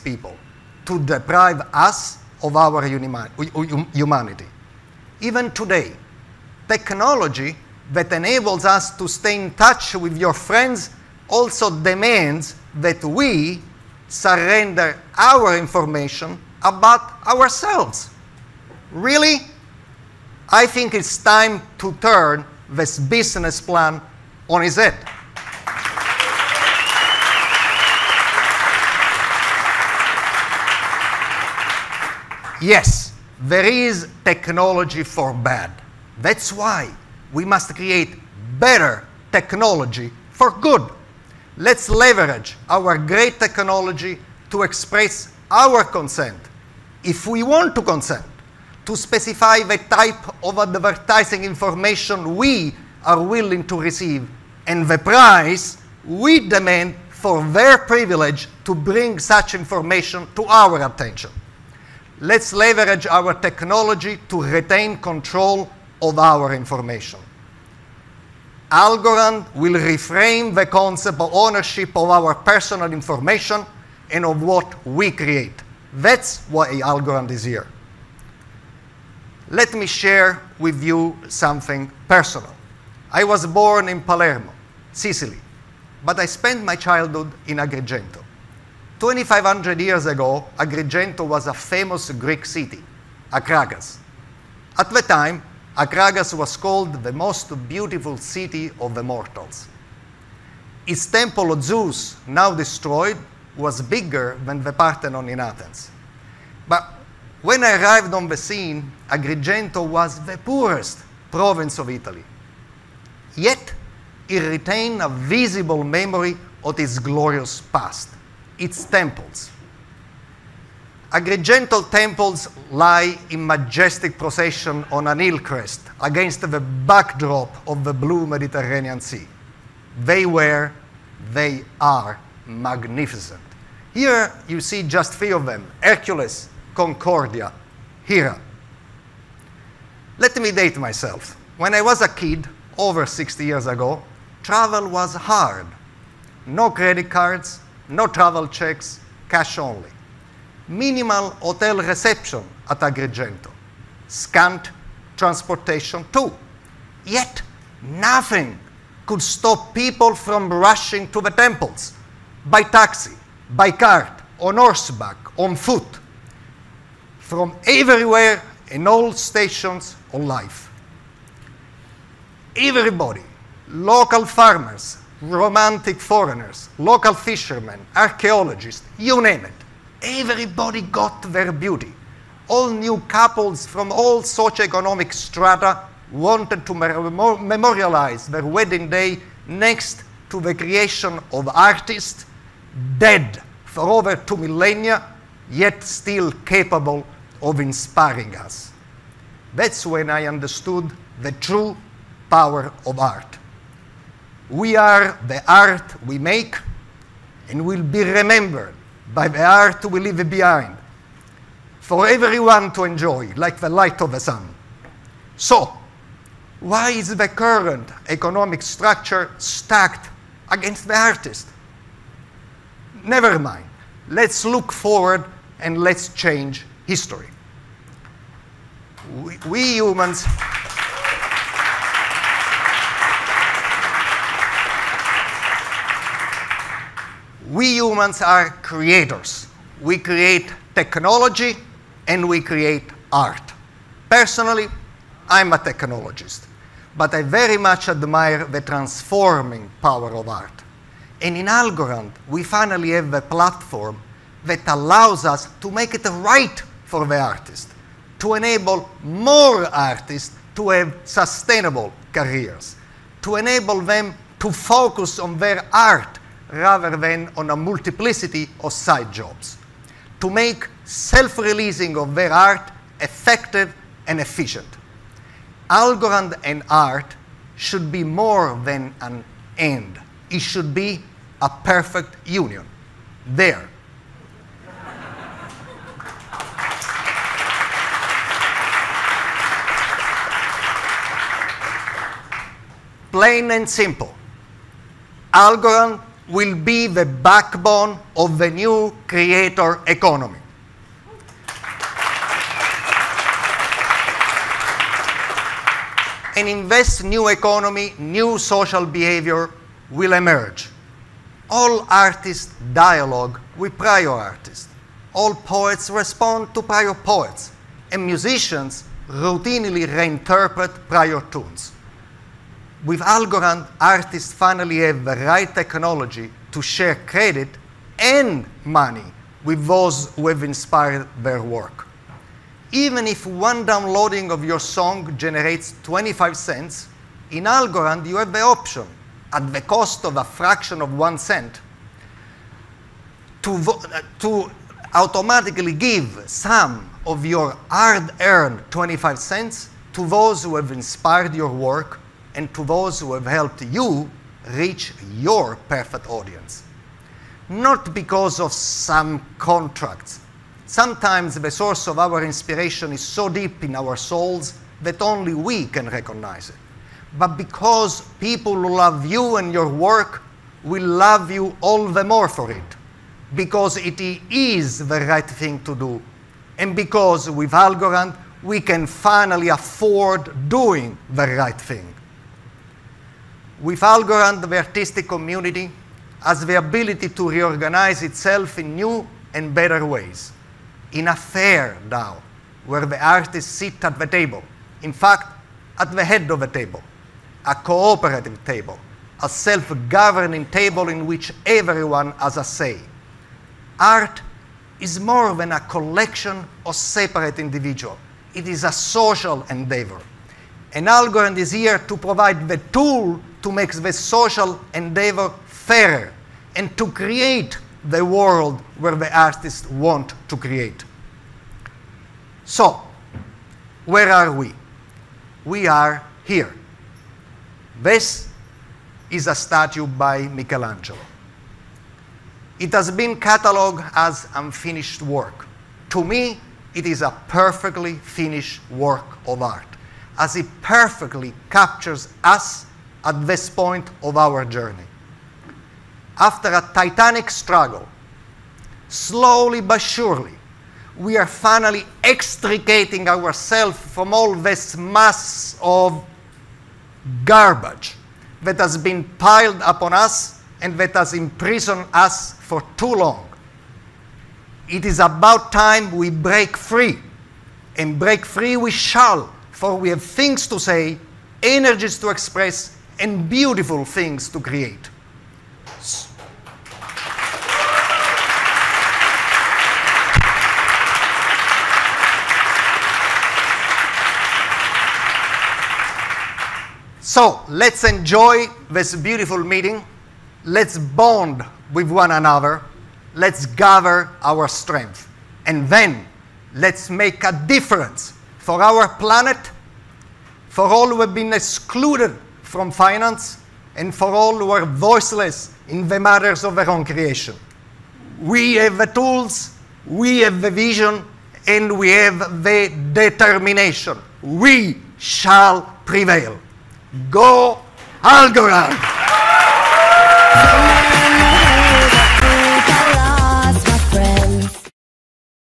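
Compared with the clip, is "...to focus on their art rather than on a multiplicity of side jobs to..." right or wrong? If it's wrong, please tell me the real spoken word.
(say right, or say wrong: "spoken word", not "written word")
right.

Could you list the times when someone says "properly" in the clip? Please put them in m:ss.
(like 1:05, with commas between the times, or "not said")
not said.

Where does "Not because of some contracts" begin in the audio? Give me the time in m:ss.
5:57.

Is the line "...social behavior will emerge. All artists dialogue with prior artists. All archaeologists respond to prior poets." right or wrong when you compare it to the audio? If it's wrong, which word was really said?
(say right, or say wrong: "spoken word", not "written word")
wrong: "poets", not "archaeologists".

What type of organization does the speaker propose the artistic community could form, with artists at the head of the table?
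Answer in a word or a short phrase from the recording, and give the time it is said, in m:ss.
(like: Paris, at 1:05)
DAO, at 6:31.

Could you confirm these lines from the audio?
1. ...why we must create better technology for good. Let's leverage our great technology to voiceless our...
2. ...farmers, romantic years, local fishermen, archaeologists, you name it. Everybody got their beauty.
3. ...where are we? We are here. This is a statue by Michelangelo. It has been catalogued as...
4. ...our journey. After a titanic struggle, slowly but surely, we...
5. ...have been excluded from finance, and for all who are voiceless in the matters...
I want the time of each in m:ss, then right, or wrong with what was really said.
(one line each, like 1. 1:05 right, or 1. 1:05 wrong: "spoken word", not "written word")
1. 0:36 wrong: "express", not "voiceless"
2. 2:54 wrong: "foreigners", not "years"
3. 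7:03 right
4. 7:24 right
5. 8:21 right.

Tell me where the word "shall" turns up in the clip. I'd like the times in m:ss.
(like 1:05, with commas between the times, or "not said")
7:48, 8:34.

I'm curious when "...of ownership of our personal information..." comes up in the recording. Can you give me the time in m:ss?
1:11.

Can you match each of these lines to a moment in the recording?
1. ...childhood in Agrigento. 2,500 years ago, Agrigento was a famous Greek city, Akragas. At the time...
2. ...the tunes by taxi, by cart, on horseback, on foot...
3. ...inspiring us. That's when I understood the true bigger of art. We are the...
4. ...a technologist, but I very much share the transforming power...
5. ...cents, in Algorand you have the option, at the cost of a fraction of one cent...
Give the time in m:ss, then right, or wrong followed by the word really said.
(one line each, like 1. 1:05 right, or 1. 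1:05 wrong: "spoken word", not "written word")
1. 1:26 right
2. 2:41 wrong: "temples", not "tunes"
3. 3:17 wrong: "power", not "bigger"
4. 4:05 wrong: "admire", not "share"
5. 5:36 right.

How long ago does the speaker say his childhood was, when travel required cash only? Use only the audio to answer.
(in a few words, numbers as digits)
over 60 years ago.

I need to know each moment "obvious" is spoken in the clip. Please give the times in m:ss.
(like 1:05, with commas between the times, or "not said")
not said.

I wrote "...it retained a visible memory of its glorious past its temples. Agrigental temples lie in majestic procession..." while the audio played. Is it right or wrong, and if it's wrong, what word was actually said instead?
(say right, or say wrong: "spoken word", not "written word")
right.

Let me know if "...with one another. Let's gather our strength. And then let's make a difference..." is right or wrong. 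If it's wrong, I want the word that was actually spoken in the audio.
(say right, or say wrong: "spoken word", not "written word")
right.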